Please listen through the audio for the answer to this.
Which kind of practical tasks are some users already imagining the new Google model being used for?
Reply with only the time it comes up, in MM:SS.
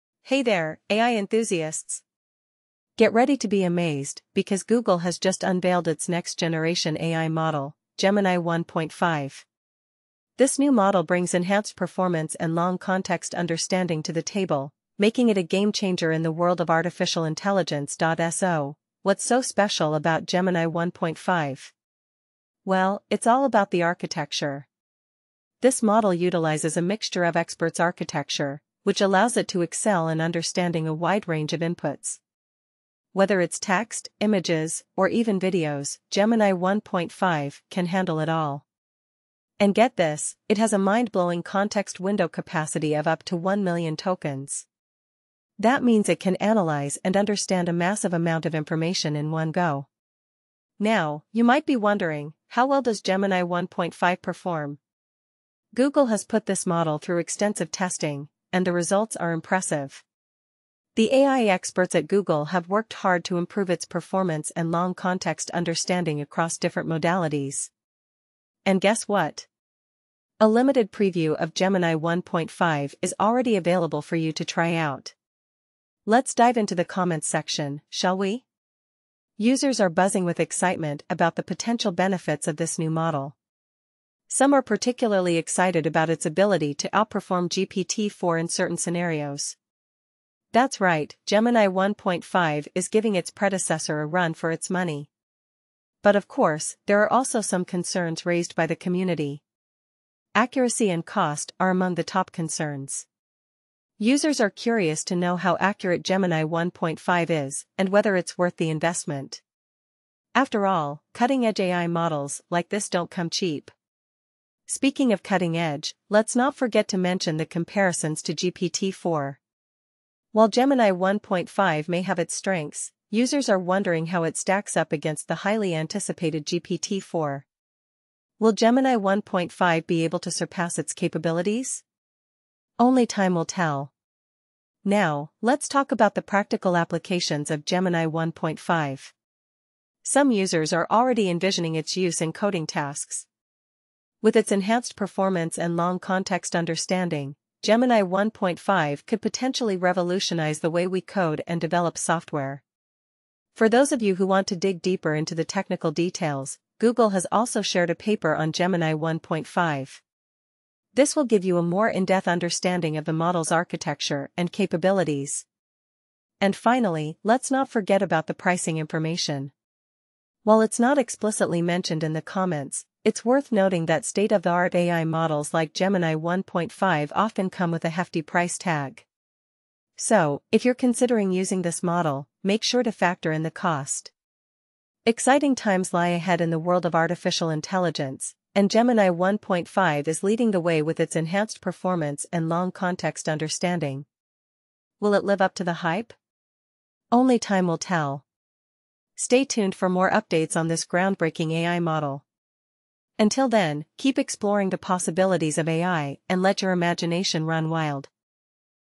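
02:22.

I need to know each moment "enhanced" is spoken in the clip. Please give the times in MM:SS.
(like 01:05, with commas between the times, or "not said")
00:11, 02:24, 03:11.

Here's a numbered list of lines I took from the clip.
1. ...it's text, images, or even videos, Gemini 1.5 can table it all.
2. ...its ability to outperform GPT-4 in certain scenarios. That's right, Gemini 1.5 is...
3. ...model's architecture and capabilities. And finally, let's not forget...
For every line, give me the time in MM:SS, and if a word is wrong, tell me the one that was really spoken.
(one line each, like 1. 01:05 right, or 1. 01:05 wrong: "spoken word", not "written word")
1. 00:33 wrong: "handle", not "table"
2. 01:26 right
3. 02:43 right.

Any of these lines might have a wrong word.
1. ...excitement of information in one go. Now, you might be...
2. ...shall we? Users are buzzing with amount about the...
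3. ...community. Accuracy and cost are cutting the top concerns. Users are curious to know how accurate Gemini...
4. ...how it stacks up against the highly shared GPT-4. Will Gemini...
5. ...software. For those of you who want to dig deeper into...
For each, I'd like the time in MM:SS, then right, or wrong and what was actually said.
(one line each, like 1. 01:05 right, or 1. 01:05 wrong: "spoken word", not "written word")
1. 00:48 wrong: "amount", not "excitement"
2. 01:17 wrong: "excitement", not "amount"
3. 01:38 wrong: "among", not "cutting"
4. 02:04 wrong: "anticipated", not "shared"
5. 02:31 right.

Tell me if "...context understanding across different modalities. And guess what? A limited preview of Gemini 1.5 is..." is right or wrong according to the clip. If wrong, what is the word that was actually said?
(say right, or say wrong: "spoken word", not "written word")
right.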